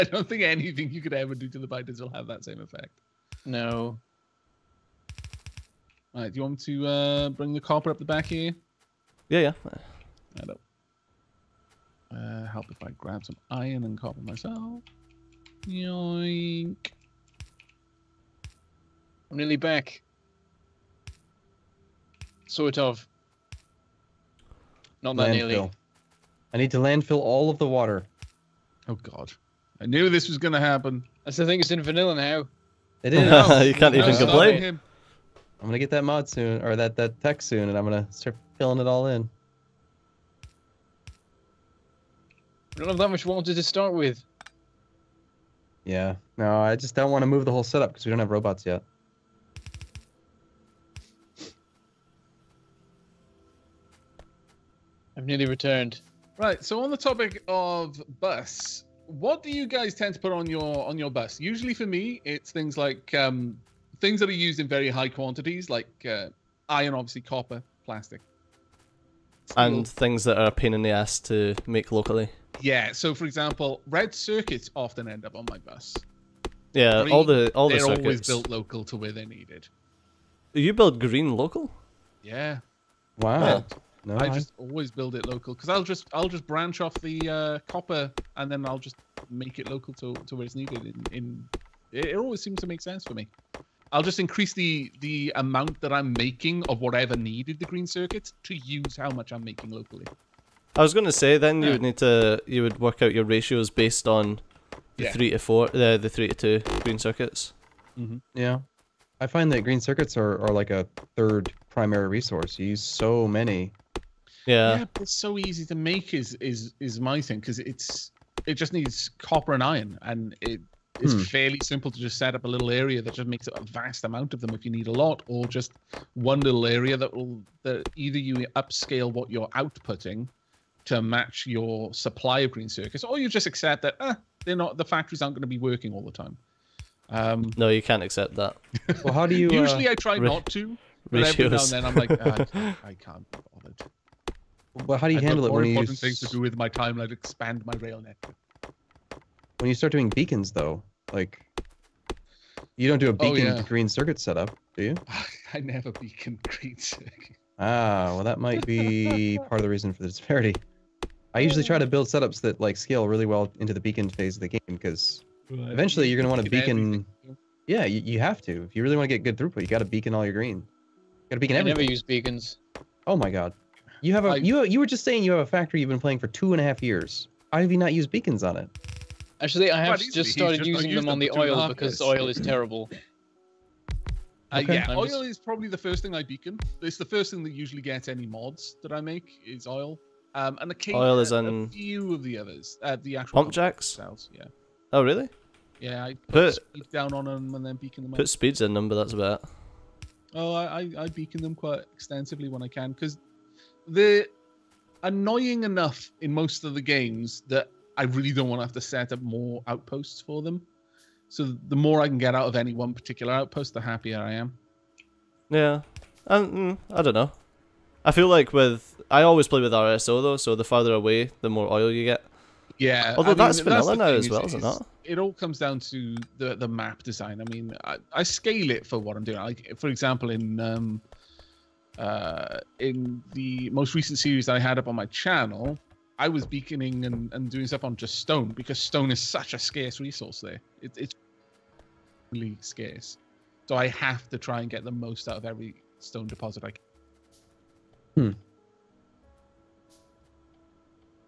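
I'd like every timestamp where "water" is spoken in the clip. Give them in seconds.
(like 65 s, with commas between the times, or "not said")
27 s, 43 s.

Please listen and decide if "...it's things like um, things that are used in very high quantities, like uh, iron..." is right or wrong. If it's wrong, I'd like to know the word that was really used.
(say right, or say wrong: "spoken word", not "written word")
right.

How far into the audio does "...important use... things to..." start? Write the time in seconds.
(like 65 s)
145 s.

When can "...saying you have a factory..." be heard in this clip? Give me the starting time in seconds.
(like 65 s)
175 s.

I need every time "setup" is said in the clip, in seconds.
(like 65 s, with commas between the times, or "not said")
47 s, 154 s, 162 s.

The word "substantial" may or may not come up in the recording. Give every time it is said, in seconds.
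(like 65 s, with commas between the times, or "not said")
not said.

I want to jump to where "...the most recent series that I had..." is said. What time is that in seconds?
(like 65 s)
233 s.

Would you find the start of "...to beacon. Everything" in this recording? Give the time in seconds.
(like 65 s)
166 s.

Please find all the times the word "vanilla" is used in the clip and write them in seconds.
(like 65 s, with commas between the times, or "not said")
31 s, 223 s.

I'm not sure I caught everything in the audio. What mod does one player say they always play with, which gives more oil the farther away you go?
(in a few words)
RSO.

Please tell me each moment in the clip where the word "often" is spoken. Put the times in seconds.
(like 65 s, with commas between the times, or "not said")
74 s.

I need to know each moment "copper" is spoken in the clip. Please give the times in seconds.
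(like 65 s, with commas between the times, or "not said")
7 s, 13 s, 67 s, 87 s, 119 s.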